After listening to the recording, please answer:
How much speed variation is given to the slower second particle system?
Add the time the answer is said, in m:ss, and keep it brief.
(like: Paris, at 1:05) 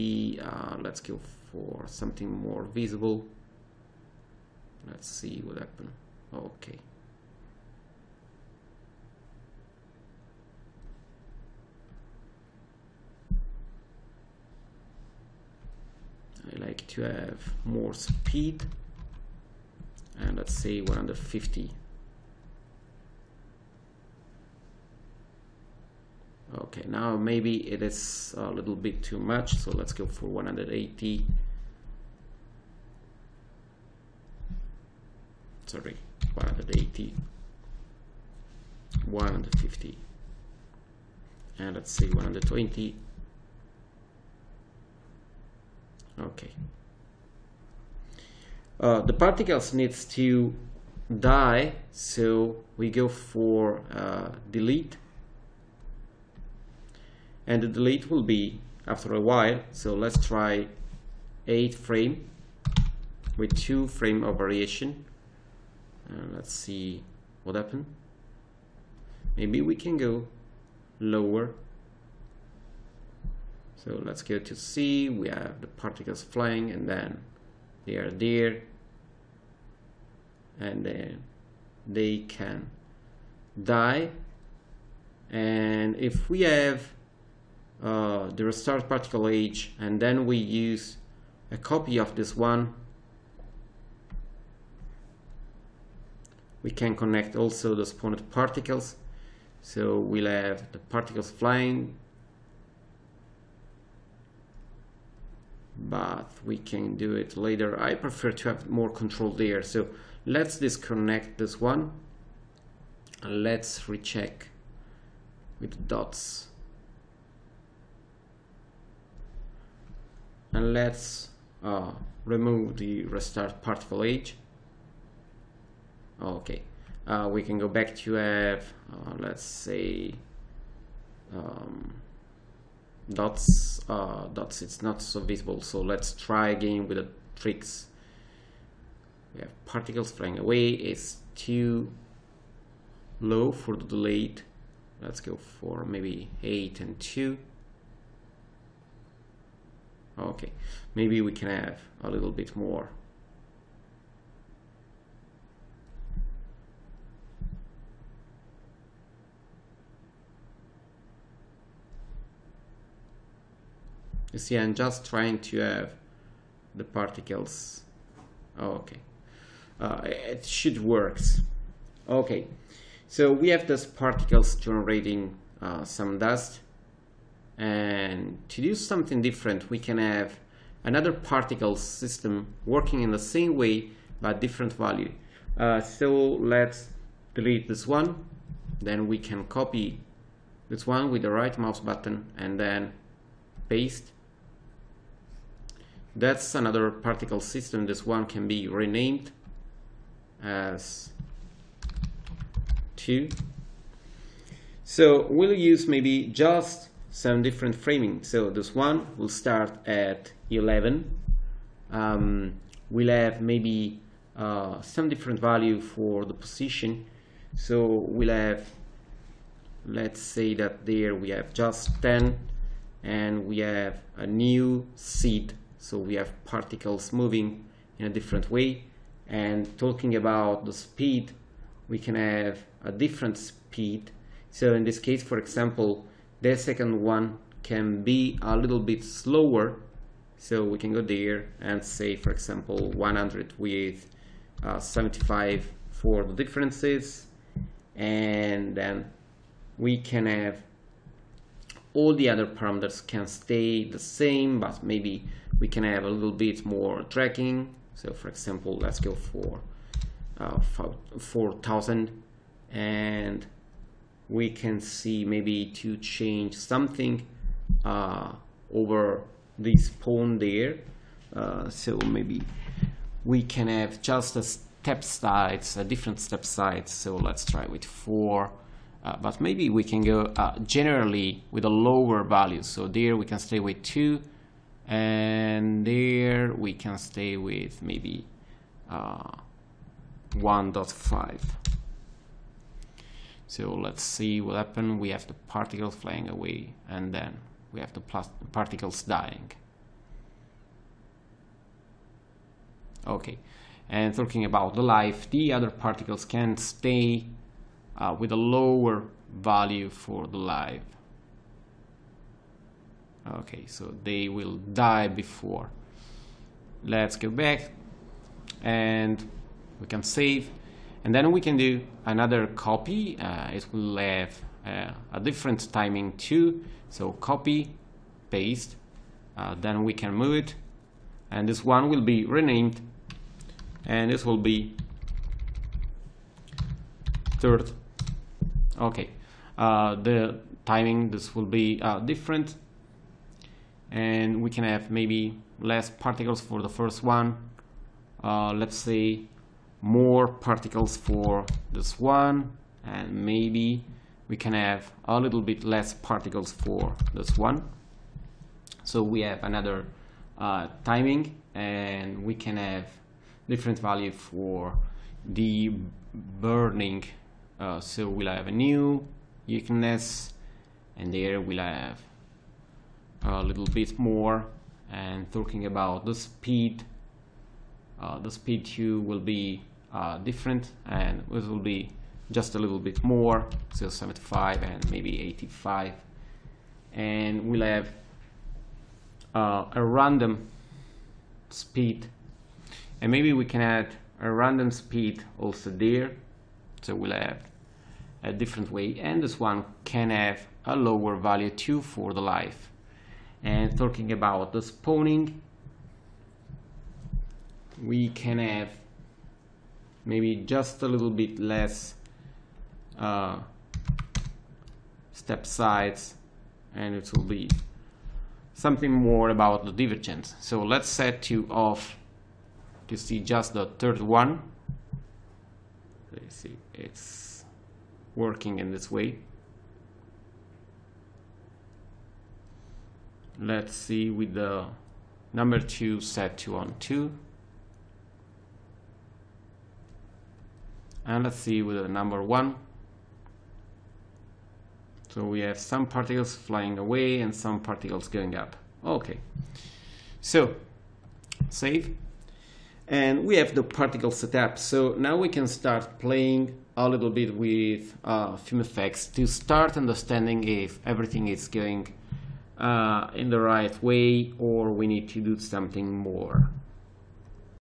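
75, at 4:04.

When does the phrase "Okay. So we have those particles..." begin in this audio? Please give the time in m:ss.
2:52.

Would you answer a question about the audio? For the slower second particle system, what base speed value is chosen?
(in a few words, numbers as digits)
100.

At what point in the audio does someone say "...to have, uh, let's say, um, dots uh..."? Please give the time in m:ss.
2:07.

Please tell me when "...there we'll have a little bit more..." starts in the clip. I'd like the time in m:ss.
6:11.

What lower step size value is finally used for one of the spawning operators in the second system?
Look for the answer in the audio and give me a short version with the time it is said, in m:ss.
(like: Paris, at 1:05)
1.5, at 4:50.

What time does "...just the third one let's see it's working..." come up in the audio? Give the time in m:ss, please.
7:03.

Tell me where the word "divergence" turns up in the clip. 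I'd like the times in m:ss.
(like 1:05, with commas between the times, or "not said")
6:59.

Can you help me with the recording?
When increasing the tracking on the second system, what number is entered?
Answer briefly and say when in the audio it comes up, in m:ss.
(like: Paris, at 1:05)
4000, at 4:21.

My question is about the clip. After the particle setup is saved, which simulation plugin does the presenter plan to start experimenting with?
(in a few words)
FumeFX.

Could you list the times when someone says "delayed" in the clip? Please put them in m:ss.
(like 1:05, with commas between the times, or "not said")
2:23.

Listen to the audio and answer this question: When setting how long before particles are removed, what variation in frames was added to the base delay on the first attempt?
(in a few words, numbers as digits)
2 frame.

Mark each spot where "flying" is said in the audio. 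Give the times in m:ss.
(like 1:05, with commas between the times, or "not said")
1:16, 1:41, 2:20, 4:55, 7:26.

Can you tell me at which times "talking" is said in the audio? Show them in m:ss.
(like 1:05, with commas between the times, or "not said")
3:49, 5:04, 6:15, 6:43.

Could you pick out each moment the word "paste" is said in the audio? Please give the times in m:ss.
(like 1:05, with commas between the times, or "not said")
3:13, 5:28.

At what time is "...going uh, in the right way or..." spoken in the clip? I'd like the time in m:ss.
7:41.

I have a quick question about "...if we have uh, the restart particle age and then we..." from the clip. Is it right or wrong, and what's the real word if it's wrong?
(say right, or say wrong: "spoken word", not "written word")
right.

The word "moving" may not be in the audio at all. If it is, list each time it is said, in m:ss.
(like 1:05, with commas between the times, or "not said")
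3:47.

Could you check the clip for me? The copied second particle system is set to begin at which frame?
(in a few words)
11.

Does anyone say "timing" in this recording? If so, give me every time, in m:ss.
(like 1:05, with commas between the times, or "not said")
5:25, 5:40, 6:00.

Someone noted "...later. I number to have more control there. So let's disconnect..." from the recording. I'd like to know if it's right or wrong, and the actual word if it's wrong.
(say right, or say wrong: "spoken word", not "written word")
wrong: "prefer", not "number".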